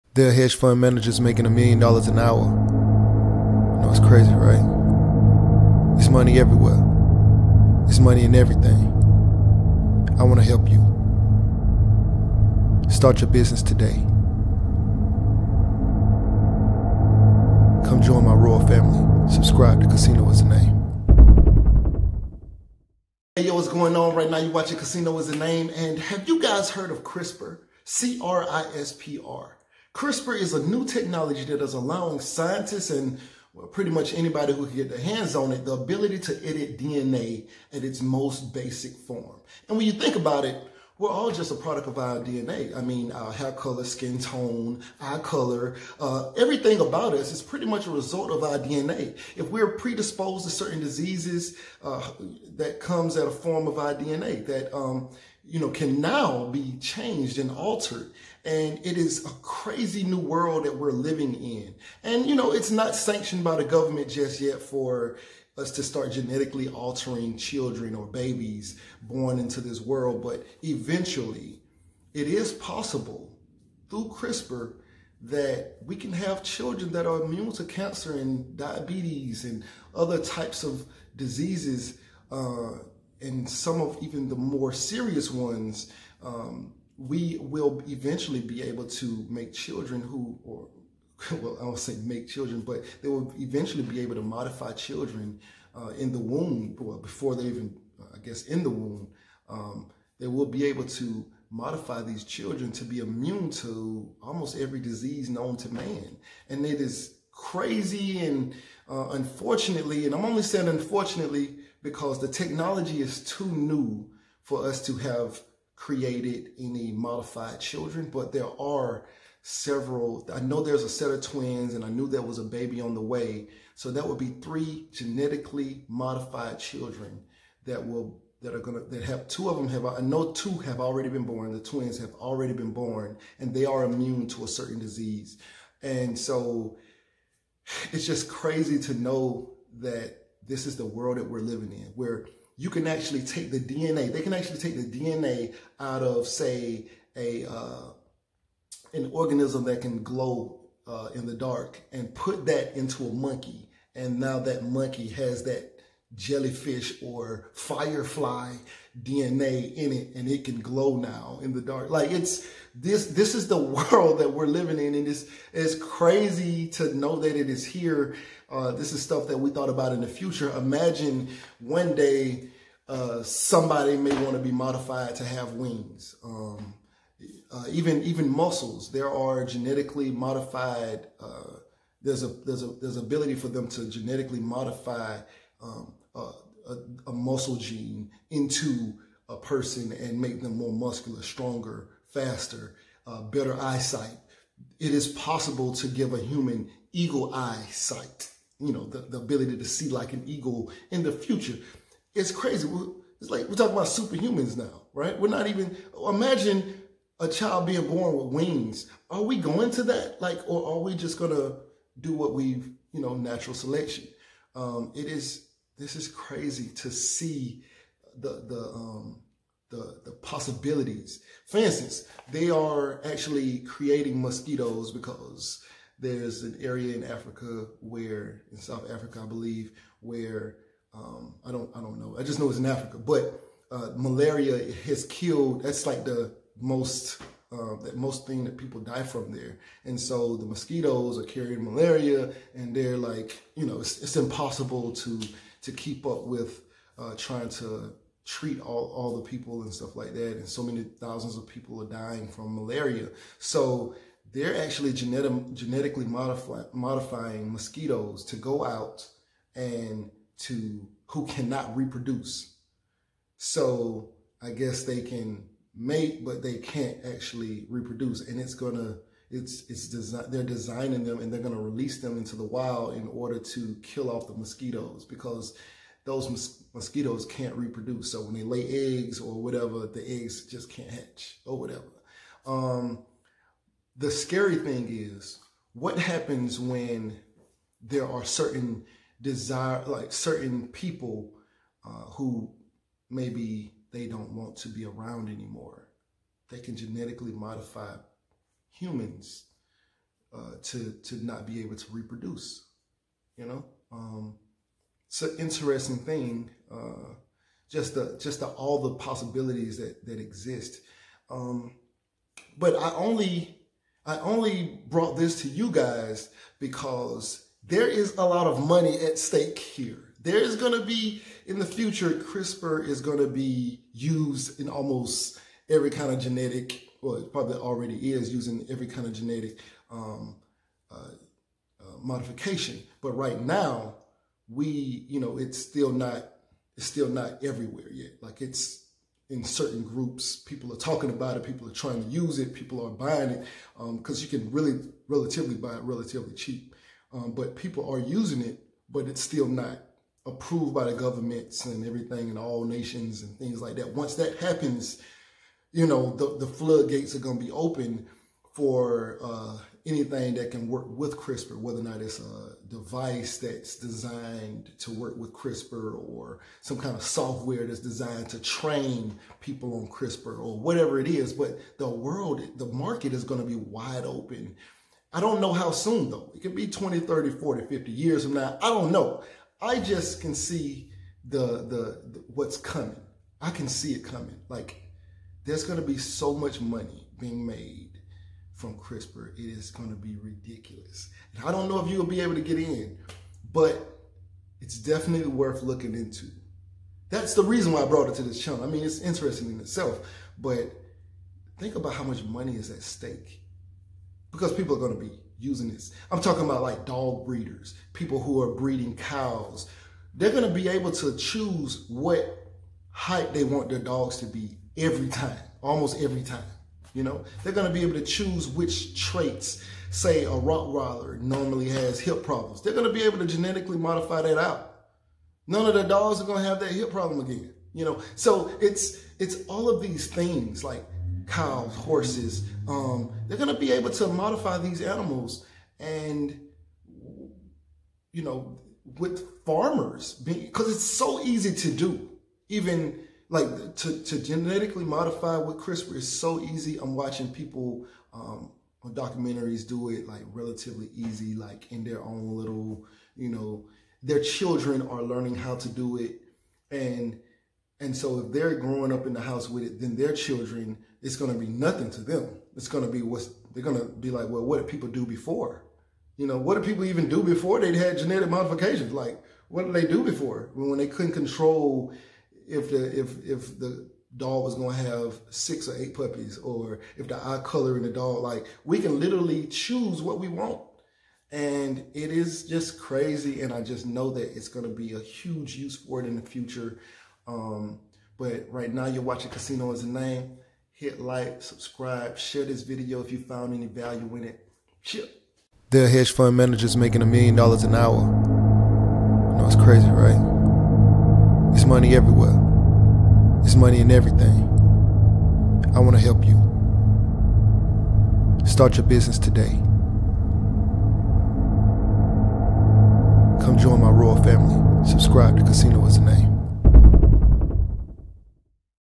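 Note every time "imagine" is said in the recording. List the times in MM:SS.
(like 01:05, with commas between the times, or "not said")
02:50, 03:26.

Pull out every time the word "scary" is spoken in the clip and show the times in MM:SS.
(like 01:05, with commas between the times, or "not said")
04:44.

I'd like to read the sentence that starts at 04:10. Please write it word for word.
And so many thousands of people are dying from malaria.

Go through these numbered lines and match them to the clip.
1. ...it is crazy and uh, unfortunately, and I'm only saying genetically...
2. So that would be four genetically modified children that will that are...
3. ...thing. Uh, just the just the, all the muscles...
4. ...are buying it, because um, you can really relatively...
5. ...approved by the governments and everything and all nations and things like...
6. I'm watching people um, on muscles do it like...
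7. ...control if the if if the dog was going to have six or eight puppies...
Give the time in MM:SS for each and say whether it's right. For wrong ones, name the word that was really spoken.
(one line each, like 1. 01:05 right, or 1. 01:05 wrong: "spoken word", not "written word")
1. 01:46 wrong: "unfortunately", not "genetically"
2. 02:03 wrong: "three", not "four"
3. 05:05 wrong: "possibilities", not "muscles"
4. 05:42 right
5. 05:50 right
6. 07:26 wrong: "documentaries", not "muscles"
7. 07:51 right.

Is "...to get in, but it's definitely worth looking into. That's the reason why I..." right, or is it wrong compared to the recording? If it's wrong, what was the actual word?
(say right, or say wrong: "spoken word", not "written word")
right.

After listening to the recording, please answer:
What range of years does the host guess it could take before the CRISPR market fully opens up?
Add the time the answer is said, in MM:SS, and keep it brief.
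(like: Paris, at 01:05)
20 to 50 years, at 06:16.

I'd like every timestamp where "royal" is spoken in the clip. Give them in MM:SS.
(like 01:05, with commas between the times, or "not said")
00:18, 08:33.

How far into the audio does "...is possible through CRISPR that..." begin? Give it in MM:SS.
01:12.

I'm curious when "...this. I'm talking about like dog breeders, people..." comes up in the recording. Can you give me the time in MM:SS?
06:45.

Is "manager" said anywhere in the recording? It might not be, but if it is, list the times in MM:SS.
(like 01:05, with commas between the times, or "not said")
00:00, 08:16.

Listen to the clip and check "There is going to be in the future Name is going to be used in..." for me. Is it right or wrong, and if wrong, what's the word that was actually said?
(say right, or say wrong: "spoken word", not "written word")
wrong: "CRISPR", not "Name".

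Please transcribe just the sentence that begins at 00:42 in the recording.
I mean, our hair color, skin tone, eye color, uh, everything about us is pretty much a result of our DNA.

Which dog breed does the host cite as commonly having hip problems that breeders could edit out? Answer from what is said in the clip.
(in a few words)
Rottweiler.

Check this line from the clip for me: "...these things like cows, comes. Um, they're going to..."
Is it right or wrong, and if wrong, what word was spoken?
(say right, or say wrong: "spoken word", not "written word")
wrong: "horses", not "comes".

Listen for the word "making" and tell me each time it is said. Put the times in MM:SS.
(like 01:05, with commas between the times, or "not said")
00:01, 08:16.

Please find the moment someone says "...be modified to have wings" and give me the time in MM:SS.
02:54.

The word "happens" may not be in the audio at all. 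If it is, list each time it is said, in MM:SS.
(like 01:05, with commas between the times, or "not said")
04:45, 05:54.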